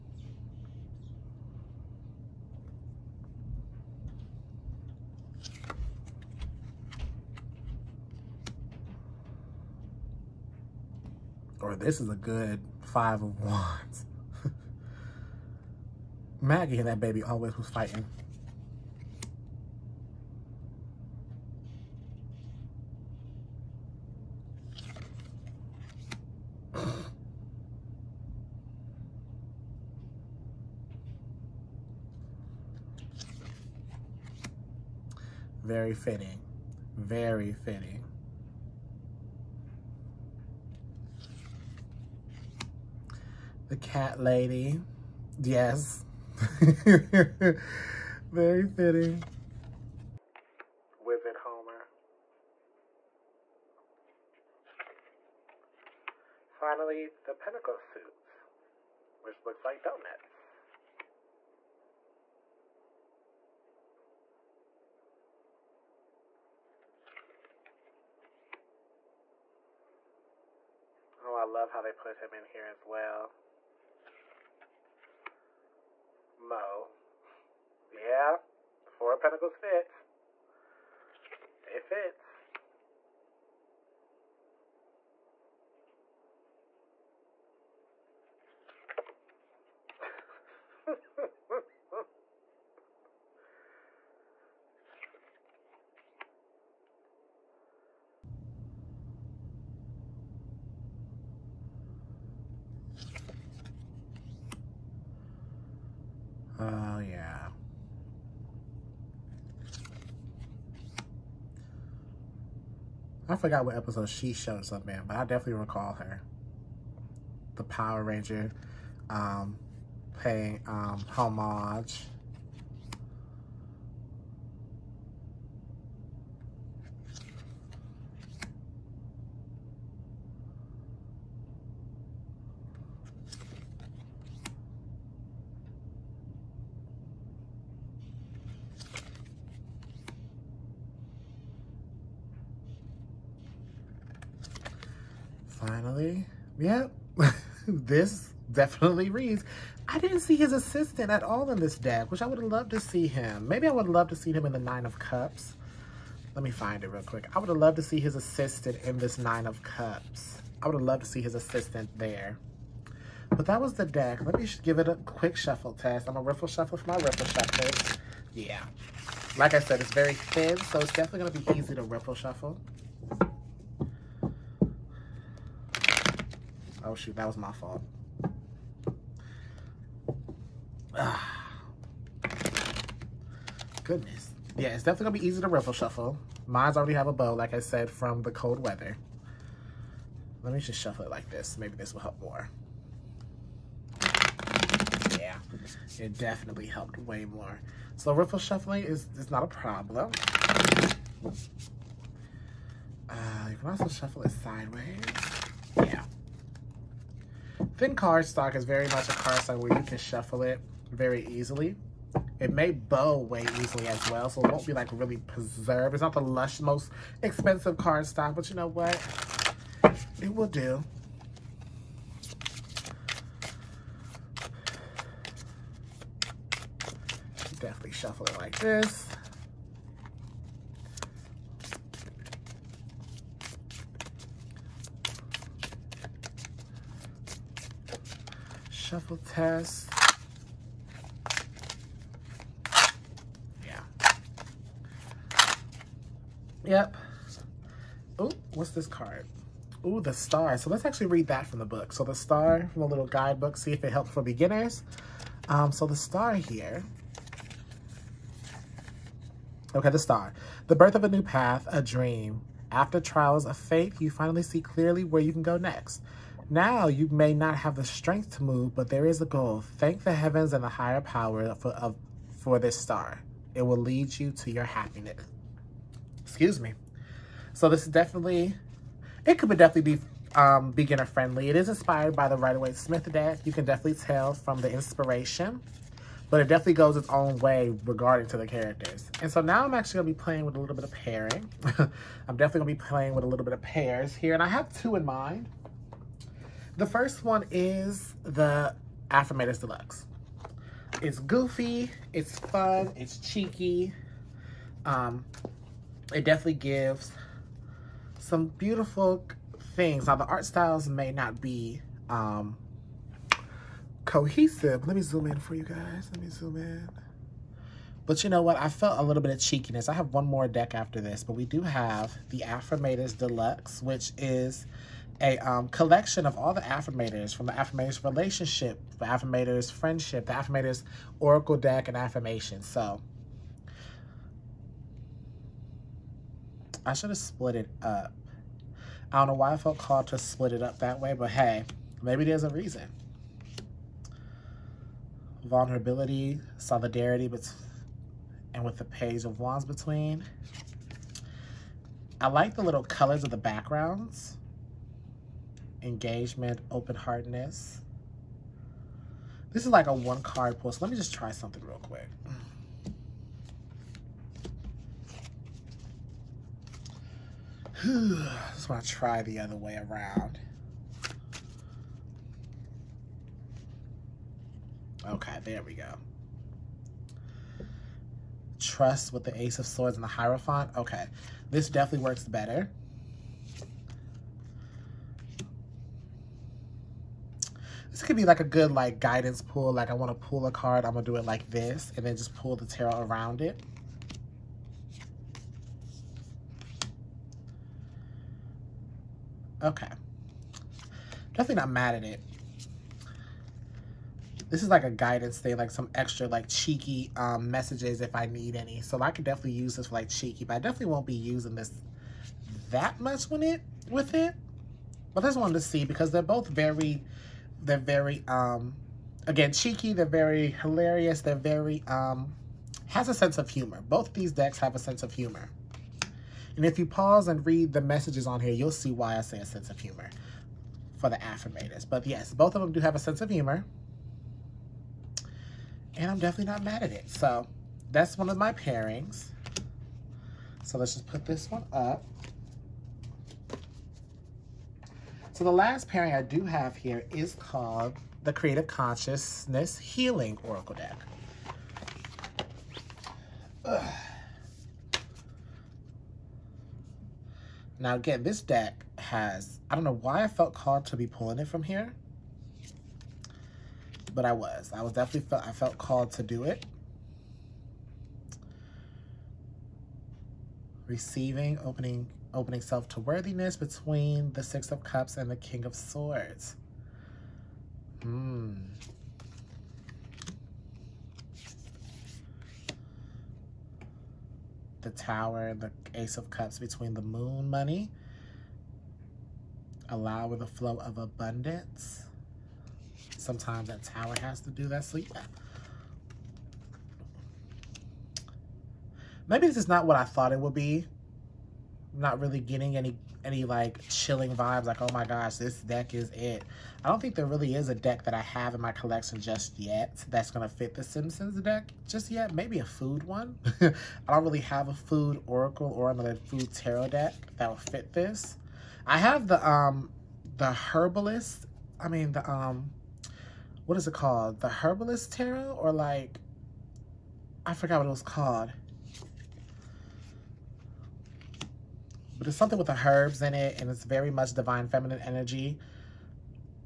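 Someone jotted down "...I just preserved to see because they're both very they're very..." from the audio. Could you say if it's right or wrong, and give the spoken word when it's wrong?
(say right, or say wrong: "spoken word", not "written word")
wrong: "wanted", not "preserved".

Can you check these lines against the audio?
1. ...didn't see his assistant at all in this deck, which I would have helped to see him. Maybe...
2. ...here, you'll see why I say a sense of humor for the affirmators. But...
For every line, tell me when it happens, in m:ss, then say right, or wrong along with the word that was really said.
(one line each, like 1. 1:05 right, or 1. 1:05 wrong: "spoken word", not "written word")
1. 2:29 wrong: "loved", not "helped"
2. 7:08 right.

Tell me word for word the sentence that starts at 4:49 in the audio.
And so now I'm actually gonna be playing with a little bit of pairing.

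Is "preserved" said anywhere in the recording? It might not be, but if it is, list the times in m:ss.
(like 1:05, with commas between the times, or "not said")
3:35.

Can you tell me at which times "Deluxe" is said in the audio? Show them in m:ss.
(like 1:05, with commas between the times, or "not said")
4:59, 5:23.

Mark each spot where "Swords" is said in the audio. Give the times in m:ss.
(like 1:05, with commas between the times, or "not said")
6:19, 7:55.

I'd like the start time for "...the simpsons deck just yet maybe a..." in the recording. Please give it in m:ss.
8:30.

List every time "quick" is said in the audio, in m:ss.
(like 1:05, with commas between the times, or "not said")
2:37, 2:44, 6:01.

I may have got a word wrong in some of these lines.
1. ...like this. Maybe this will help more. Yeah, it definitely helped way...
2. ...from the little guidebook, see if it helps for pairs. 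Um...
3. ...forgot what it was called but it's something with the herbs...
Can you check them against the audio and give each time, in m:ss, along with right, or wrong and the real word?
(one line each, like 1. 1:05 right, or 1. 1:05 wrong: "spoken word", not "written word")
1. 3:11 right
2. 4:12 wrong: "beginners", not "pairs"
3. 8:47 right.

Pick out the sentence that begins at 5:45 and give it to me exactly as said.
Vulnerability, solidarity, but and with the page of wands between.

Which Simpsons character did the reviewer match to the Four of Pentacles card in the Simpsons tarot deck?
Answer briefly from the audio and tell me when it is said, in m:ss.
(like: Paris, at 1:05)
Moe, at 1:16.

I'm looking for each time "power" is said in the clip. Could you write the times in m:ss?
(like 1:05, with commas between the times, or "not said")
1:57, 4:31.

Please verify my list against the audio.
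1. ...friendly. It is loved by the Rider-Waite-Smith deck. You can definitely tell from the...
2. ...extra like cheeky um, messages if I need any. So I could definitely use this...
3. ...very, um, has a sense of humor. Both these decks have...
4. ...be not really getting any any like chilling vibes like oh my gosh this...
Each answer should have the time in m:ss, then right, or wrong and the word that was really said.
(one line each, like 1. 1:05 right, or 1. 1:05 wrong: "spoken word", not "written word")
1. 4:41 wrong: "inspired", not "loved"
2. 6:45 right
3. 7:01 right
4. 8:20 right.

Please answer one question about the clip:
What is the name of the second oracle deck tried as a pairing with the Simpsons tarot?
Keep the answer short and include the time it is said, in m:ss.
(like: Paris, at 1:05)
Creative Consciousness Healing Oracle, at 7:28.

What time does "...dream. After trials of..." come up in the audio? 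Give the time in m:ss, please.
4:21.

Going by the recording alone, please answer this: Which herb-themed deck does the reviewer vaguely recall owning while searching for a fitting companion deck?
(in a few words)
The Herbalist Tarot.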